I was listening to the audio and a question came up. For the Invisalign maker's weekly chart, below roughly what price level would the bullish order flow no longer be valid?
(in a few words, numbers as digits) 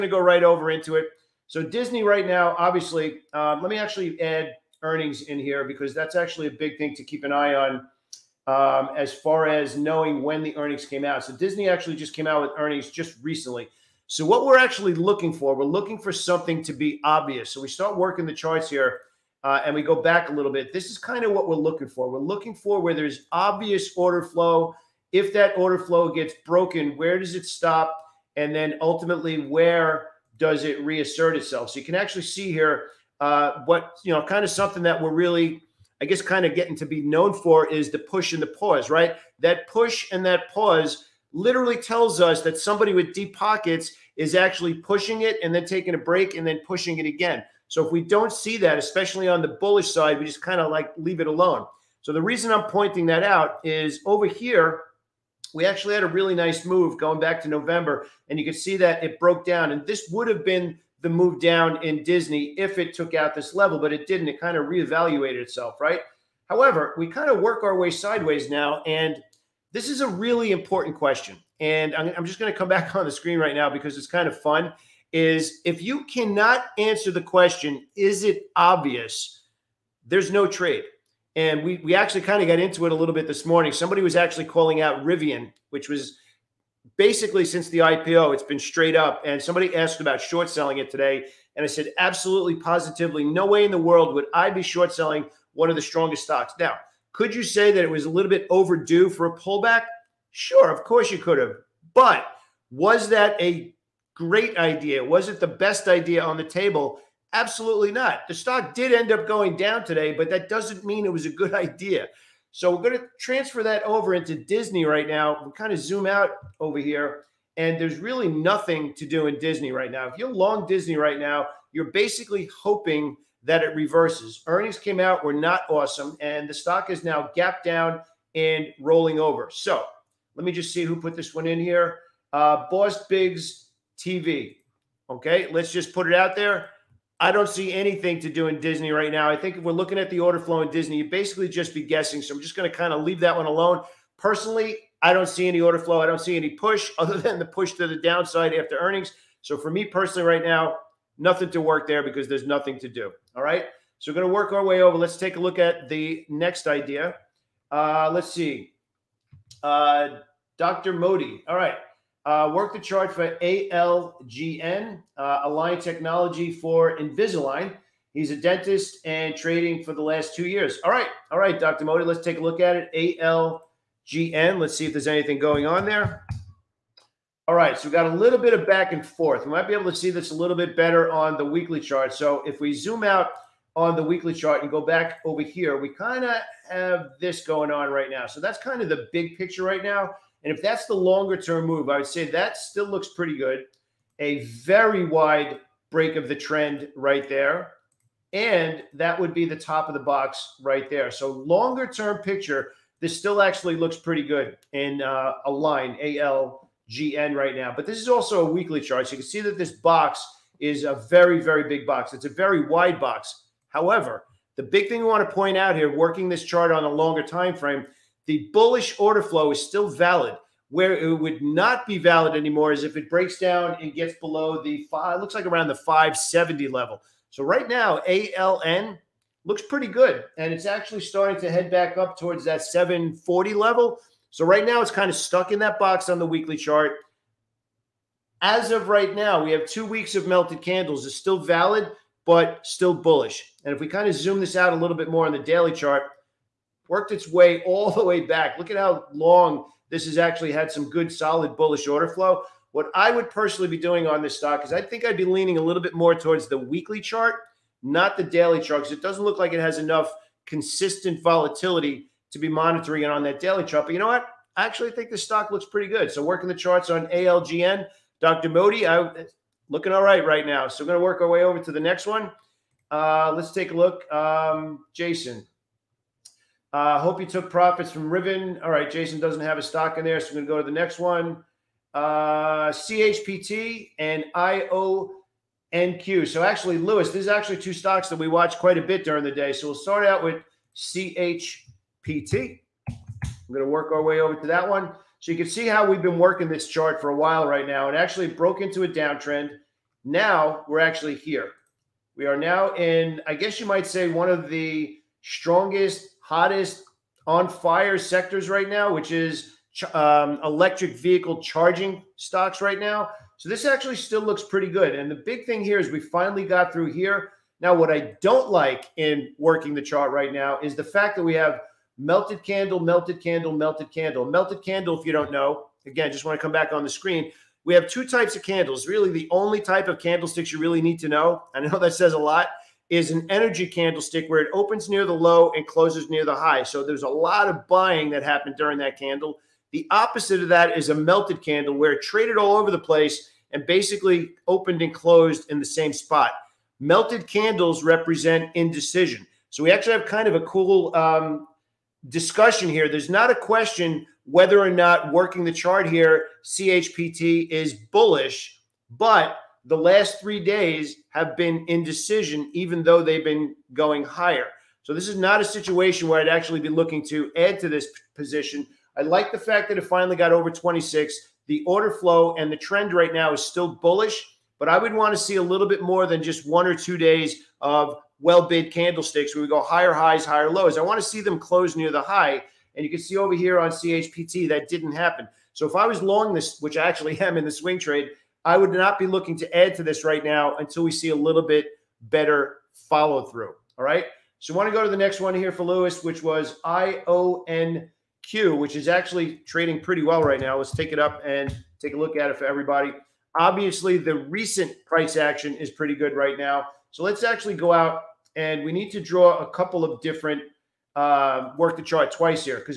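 570.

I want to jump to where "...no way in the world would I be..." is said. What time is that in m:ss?
1:33.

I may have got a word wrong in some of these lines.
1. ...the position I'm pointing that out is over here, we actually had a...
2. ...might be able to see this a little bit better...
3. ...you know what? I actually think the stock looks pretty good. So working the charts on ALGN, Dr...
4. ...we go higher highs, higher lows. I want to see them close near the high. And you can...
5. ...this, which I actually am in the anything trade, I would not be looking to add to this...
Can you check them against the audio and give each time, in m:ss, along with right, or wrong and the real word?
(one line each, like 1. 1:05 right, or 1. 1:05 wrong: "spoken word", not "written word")
1. 0:52 wrong: "reason", not "position"
2. 2:59 right
3. 4:23 right
4. 6:19 right
5. 6:26 wrong: "swing", not "anything".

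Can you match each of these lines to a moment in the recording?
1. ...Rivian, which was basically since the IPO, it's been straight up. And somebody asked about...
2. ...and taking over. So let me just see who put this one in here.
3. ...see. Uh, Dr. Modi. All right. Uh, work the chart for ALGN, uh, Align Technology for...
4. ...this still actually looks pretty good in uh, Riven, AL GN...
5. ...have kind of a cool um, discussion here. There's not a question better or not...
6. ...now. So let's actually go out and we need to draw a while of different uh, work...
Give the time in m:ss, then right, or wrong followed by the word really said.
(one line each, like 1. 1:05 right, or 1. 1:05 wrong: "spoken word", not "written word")
1. 1:25 right
2. 2:08 wrong: "rolling", not "taking"
3. 2:38 right
4. 3:22 wrong: "Align", not "Riven"
5. 5:49 wrong: "whether", not "better"
6. 6:46 wrong: "couple", not "while".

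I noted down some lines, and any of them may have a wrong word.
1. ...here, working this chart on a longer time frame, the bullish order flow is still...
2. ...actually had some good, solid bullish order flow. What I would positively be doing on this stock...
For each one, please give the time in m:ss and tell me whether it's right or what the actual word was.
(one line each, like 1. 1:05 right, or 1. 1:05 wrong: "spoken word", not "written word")
1. 3:35 right
2. 4:10 wrong: "personally", not "positively".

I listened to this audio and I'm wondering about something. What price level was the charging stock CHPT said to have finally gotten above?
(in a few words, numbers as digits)
26.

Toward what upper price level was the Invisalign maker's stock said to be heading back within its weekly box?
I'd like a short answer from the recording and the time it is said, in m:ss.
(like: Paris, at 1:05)
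740, at 3:52.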